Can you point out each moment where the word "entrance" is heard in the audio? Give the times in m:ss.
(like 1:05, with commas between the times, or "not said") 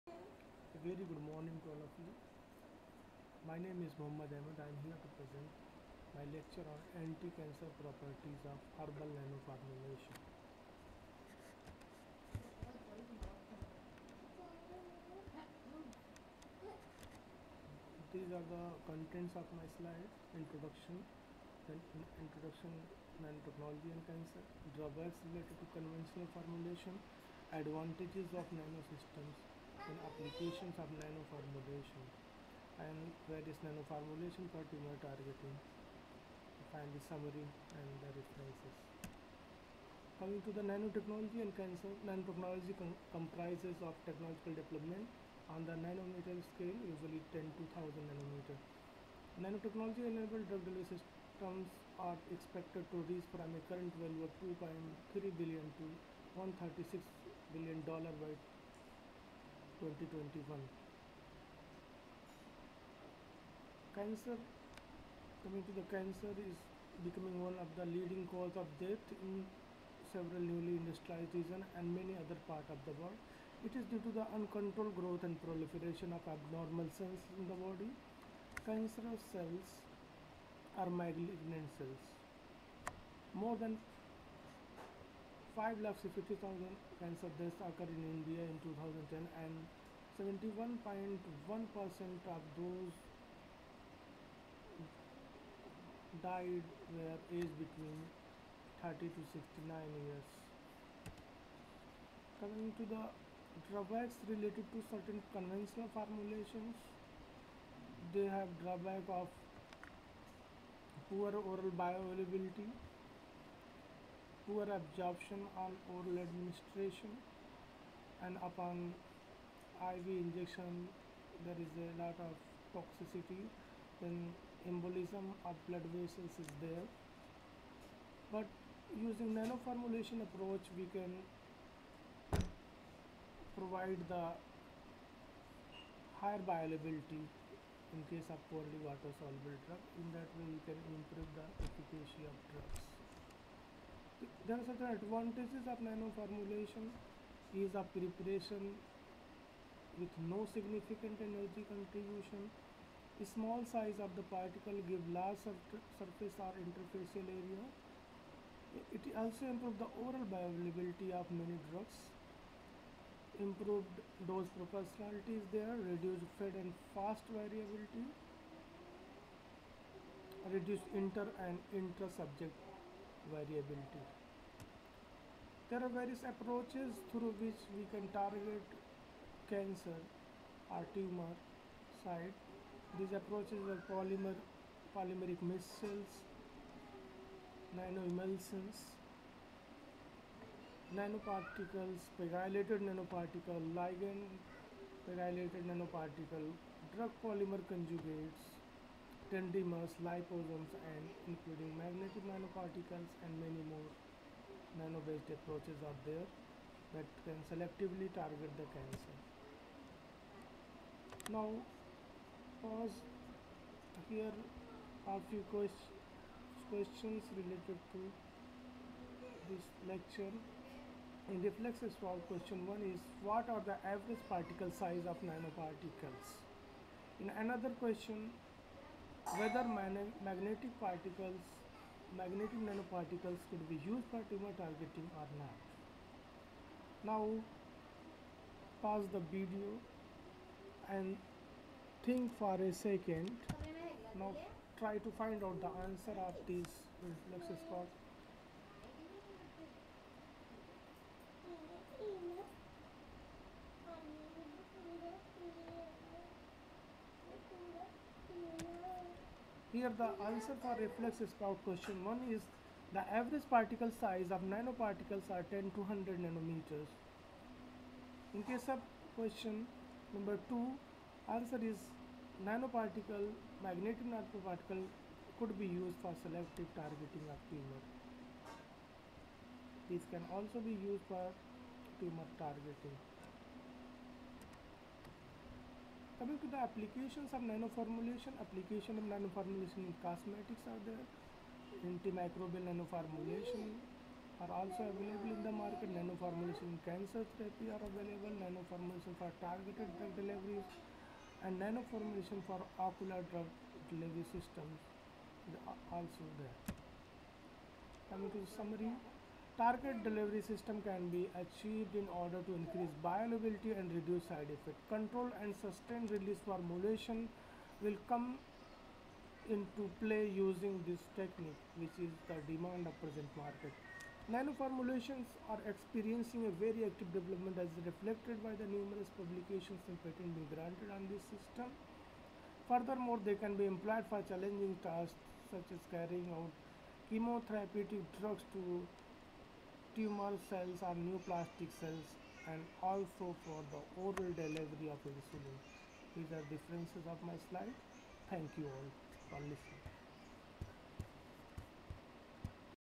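not said.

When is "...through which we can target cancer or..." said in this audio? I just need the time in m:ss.
2:57.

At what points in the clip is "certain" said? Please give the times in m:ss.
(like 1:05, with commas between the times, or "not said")
1:44, 2:24.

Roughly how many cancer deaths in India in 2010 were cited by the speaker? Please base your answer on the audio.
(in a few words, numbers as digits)
550,000.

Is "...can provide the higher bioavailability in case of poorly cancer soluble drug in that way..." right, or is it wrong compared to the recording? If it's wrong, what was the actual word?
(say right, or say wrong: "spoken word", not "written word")
wrong: "water", not "cancer".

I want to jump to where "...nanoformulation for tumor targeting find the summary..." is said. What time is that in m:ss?
0:33.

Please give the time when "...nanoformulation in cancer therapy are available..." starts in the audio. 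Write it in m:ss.
4:55.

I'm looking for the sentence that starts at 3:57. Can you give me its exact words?
Now pause the video and think for a second.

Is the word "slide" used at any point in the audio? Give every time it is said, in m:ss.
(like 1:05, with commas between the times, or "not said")
0:19, 5:47.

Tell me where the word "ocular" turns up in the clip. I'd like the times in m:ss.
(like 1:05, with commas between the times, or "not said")
5:02.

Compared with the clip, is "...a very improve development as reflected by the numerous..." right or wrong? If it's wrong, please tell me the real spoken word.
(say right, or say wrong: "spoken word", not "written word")
wrong: "active", not "improve".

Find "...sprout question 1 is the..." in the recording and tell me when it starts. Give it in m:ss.
4:21.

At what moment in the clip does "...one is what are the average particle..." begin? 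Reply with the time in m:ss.
3:42.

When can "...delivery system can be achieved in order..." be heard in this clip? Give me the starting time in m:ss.
5:10.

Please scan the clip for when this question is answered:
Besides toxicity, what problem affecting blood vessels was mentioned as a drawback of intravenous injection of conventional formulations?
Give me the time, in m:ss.
2:04.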